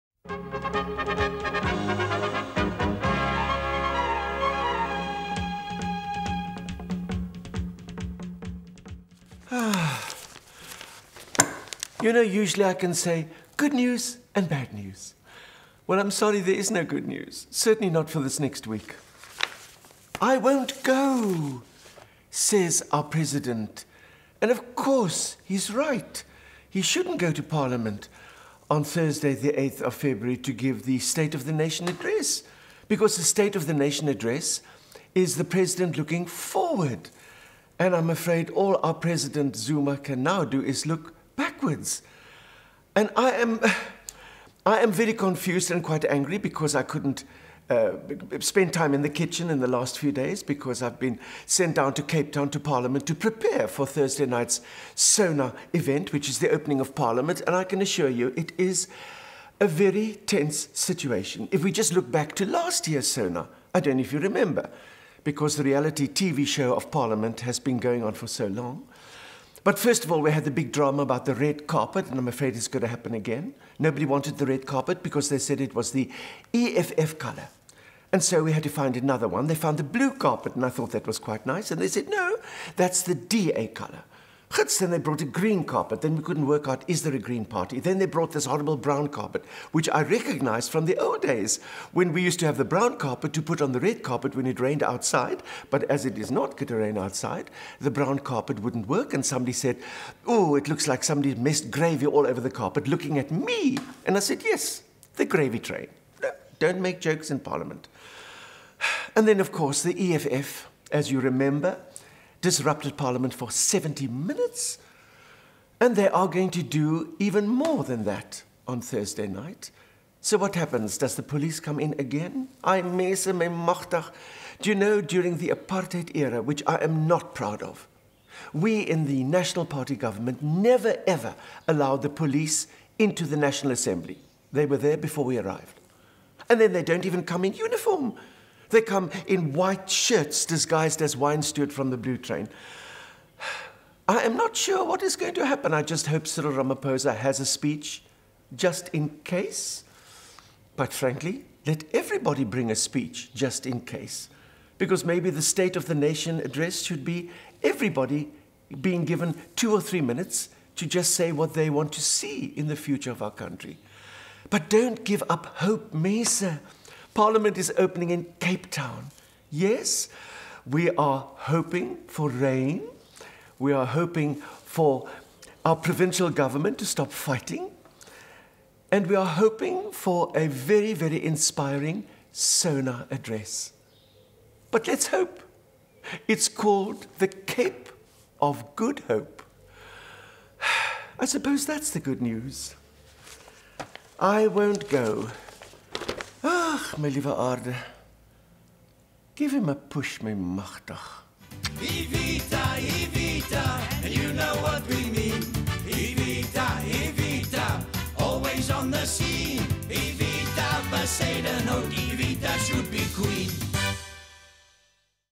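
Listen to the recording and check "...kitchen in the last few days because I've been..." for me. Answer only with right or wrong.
right.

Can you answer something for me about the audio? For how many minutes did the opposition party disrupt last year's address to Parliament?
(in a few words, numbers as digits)
70.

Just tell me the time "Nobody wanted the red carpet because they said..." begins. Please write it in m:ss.
1:13.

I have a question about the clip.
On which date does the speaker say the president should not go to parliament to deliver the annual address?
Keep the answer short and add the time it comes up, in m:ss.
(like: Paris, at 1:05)
Thursday, 8 February, at 0:28.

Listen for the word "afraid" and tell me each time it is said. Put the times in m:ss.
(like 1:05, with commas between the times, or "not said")
0:38, 1:12.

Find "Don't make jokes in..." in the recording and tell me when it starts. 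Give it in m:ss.
1:46.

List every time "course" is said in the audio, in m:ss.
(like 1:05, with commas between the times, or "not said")
0:24, 1:49.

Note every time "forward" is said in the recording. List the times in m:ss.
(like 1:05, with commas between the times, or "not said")
0:36.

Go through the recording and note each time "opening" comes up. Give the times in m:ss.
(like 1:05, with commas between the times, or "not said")
0:56, 2:47.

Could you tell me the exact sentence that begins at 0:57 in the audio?
And I can assure you, it is a very tense situation.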